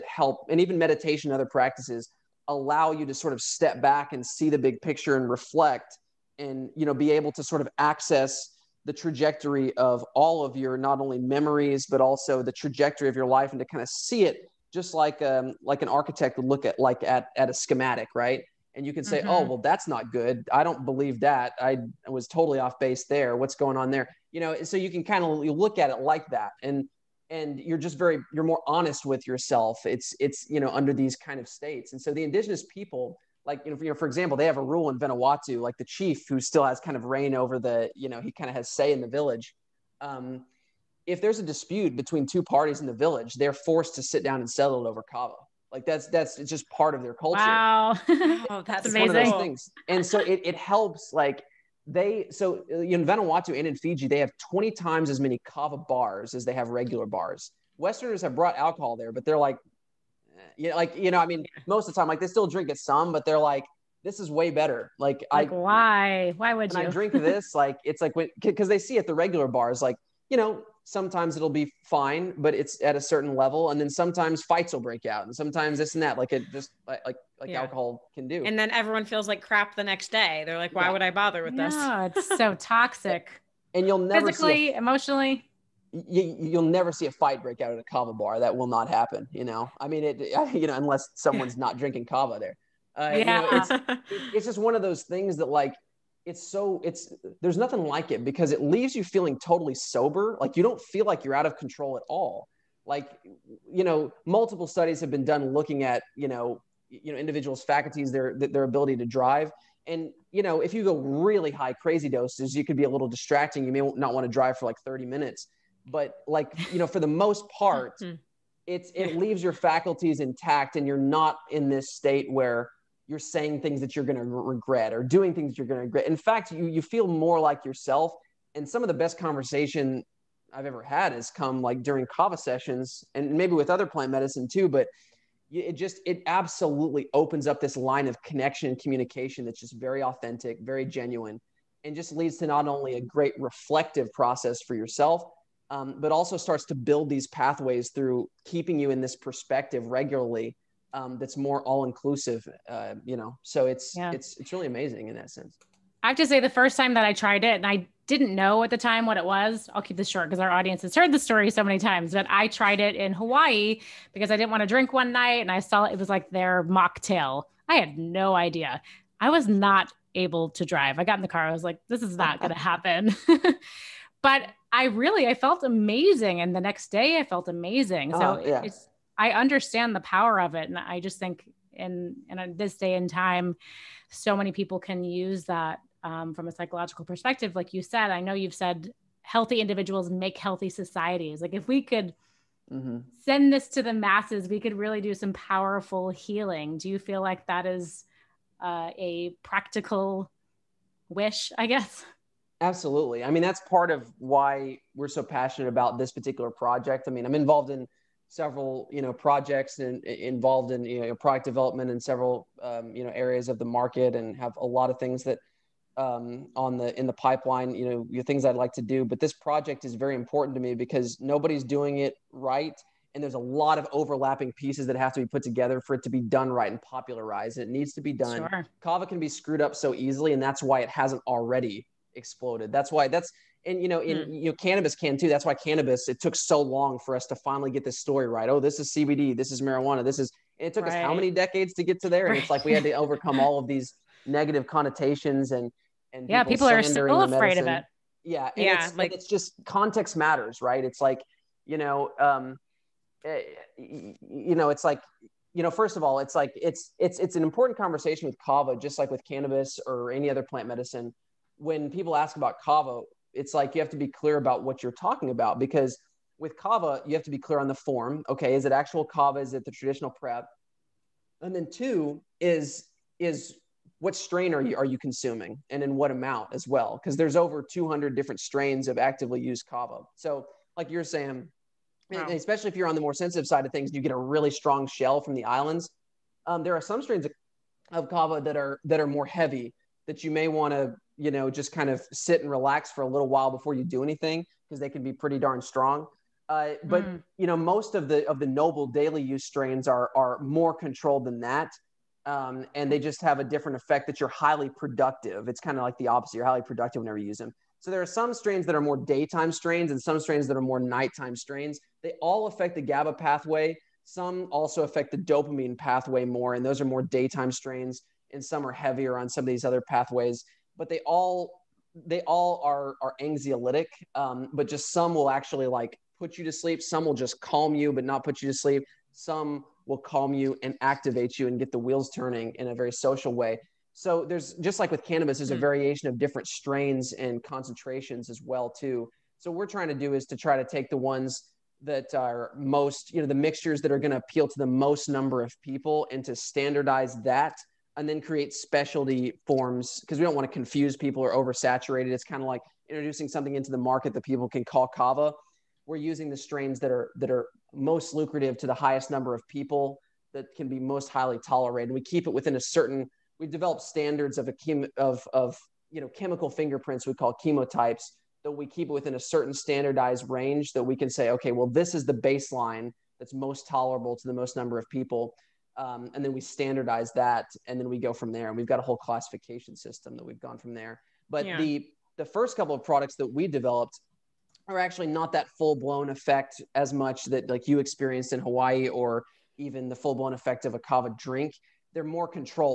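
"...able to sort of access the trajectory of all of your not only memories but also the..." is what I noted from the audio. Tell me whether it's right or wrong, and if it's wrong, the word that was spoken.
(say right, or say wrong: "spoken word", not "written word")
right.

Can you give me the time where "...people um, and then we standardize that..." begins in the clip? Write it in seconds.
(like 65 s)
374 s.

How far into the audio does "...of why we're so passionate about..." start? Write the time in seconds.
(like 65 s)
203 s.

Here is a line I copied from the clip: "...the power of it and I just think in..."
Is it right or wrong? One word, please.
right.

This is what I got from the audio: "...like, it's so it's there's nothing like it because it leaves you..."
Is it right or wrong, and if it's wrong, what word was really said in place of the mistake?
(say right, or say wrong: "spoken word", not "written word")
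right.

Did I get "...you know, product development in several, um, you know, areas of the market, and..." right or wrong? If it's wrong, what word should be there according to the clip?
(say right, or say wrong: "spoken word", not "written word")
right.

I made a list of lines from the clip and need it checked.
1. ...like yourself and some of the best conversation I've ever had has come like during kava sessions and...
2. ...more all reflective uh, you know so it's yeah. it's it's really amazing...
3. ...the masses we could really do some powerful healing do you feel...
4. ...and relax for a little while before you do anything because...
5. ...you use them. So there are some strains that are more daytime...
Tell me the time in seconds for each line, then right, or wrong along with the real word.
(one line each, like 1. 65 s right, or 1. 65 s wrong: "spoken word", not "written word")
1. 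127 s right
2. 151 s wrong: "inclusive", not "reflective"
3. 193 s right
4. 292 s right
5. 307 s right.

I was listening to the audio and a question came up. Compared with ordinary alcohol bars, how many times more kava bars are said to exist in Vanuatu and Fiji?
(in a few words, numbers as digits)
20.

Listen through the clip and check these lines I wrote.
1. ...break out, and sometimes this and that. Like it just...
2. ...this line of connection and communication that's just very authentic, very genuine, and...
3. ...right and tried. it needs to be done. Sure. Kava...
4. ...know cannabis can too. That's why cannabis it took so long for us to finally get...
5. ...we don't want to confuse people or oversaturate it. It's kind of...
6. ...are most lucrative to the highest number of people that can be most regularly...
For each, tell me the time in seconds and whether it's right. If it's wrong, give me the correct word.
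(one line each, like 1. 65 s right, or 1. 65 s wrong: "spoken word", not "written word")
1. 74 s right
2. 137 s right
3. 226 s wrong: "popularized", not "tried"
4. 234 s right
5. 350 s right
6. 357 s wrong: "highly", not "regularly".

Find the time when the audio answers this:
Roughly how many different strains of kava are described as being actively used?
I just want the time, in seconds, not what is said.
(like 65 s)
277 s.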